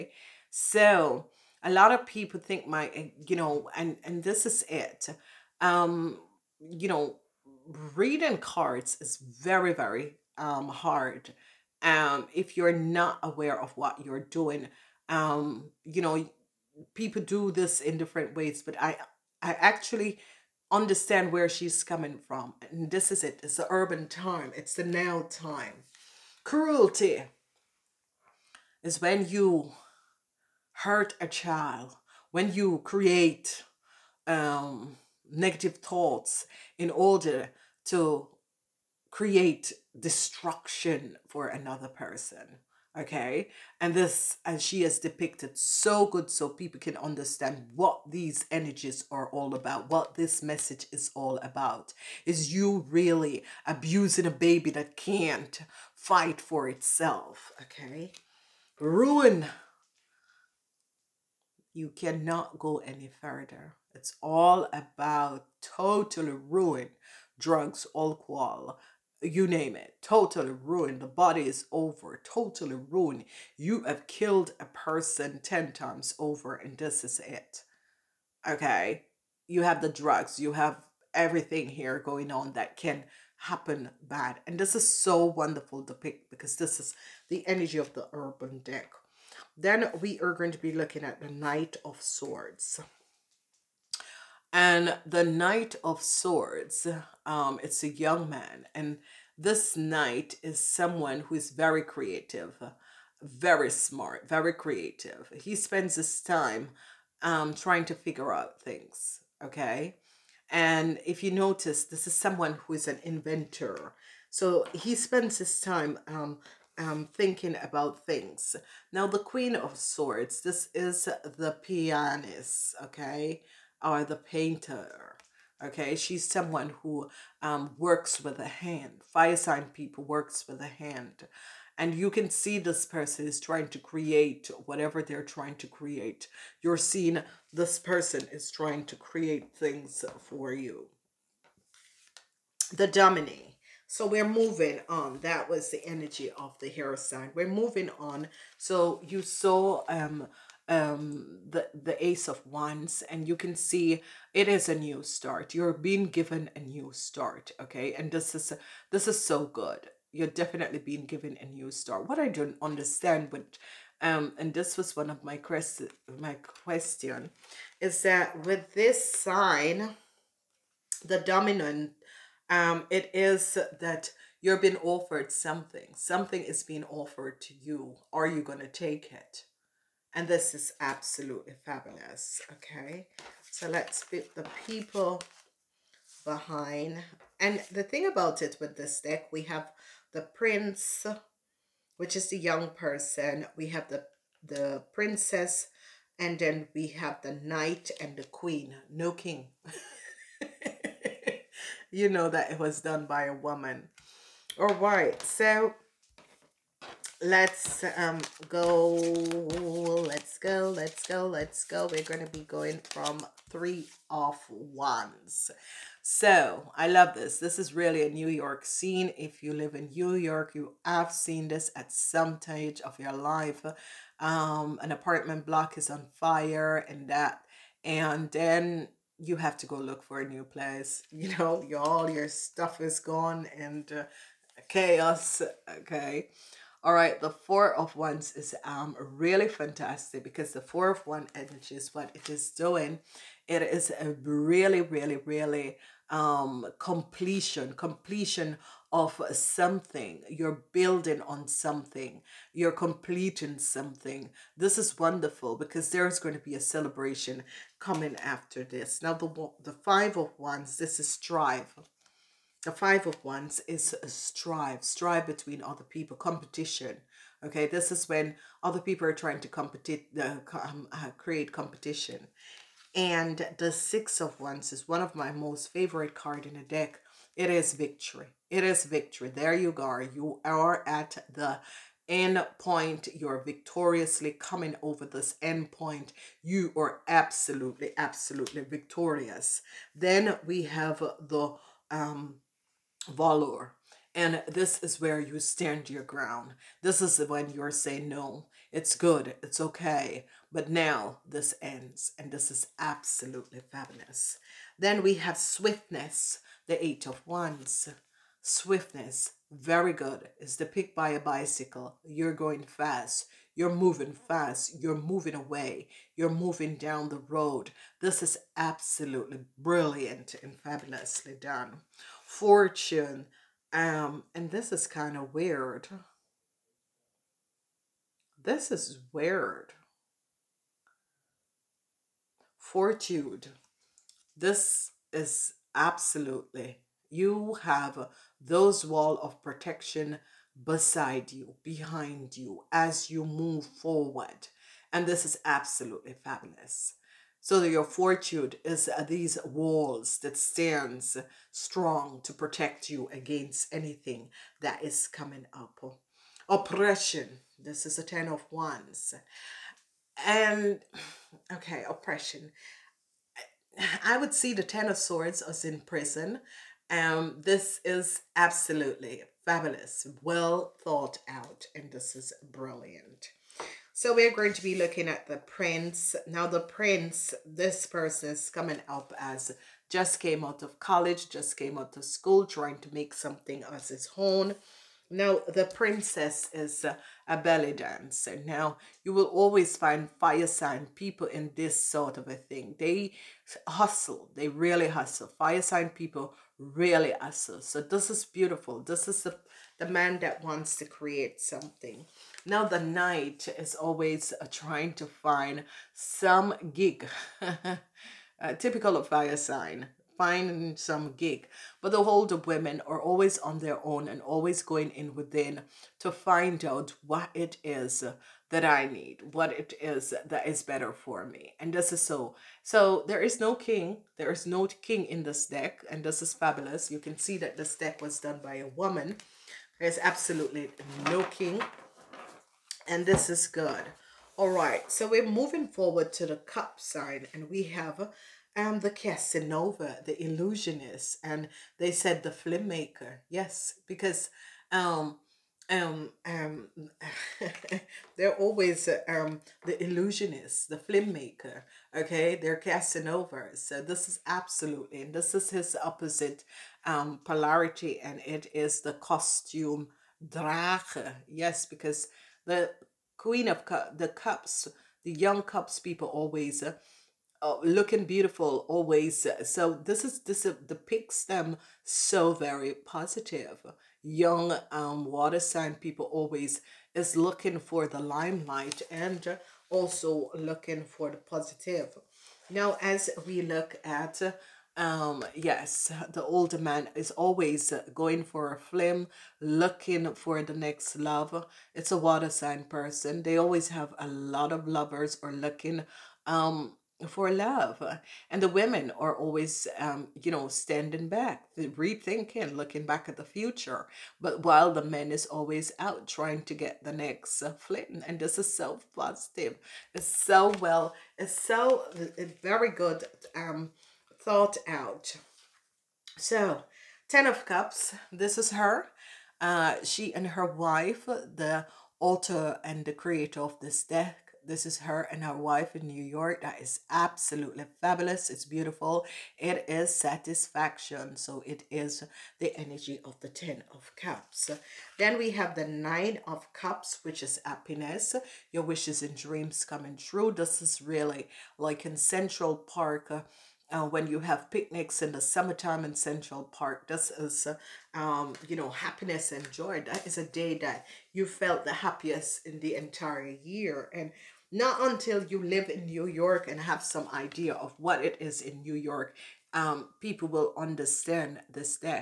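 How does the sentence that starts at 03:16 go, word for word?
And then we have the knight and the queen.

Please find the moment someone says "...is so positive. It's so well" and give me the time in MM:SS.
08:28.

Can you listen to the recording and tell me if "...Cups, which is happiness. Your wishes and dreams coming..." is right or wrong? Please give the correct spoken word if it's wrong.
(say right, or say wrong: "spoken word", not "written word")
right.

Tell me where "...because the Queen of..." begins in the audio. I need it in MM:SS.
07:41.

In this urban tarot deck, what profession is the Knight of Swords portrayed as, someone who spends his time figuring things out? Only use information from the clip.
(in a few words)
Inventor.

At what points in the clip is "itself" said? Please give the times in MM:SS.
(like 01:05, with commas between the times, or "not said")
00:56.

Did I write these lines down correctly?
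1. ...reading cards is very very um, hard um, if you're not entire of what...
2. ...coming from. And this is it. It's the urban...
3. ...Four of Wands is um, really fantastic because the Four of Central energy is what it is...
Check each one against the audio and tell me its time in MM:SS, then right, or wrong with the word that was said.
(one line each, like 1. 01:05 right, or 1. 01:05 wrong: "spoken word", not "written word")
1. 00:07 wrong: "aware", not "entire"
2. 00:21 right
3. 03:57 wrong: "One", not "Central".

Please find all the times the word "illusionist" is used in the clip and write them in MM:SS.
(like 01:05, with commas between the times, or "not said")
07:20, 07:29.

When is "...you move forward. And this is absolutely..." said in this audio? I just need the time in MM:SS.
05:43.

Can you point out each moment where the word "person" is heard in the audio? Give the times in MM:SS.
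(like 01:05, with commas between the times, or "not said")
00:41, 01:14, 02:12, 02:17, 03:12, 06:17, 08:12.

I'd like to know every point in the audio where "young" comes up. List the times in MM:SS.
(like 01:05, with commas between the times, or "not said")
01:37, 03:12, 07:45, 07:54.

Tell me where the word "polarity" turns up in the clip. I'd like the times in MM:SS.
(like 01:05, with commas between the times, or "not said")
07:37.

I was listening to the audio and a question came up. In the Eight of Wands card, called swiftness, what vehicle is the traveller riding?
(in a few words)
Bicycle.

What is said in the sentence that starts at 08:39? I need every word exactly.
Uh, she and her wife, the author and the creator of this deck, this is her and her wife in New York.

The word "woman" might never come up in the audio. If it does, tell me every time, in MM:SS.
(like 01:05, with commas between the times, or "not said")
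03:23, 07:08.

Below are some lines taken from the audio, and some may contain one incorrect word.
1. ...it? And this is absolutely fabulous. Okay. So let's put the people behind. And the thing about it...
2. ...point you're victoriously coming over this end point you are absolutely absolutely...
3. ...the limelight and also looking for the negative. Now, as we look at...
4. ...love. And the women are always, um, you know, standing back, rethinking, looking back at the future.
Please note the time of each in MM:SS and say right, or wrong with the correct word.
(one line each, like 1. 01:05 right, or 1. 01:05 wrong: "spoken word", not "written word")
1. 02:59 right
2. 04:42 right
3. 07:57 wrong: "positive", not "negative"
4. 08:17 right.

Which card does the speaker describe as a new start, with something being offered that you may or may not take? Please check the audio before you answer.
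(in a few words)
Ace of Wands.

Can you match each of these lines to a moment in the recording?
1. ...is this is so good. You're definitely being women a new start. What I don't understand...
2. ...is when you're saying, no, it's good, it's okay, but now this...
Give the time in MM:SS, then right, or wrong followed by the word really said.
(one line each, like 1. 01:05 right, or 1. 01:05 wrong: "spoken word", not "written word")
1. 02:38 wrong: "given", not "women"
2. 04:56 right.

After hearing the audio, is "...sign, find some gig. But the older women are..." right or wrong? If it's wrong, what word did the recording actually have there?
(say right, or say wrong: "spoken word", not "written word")
right.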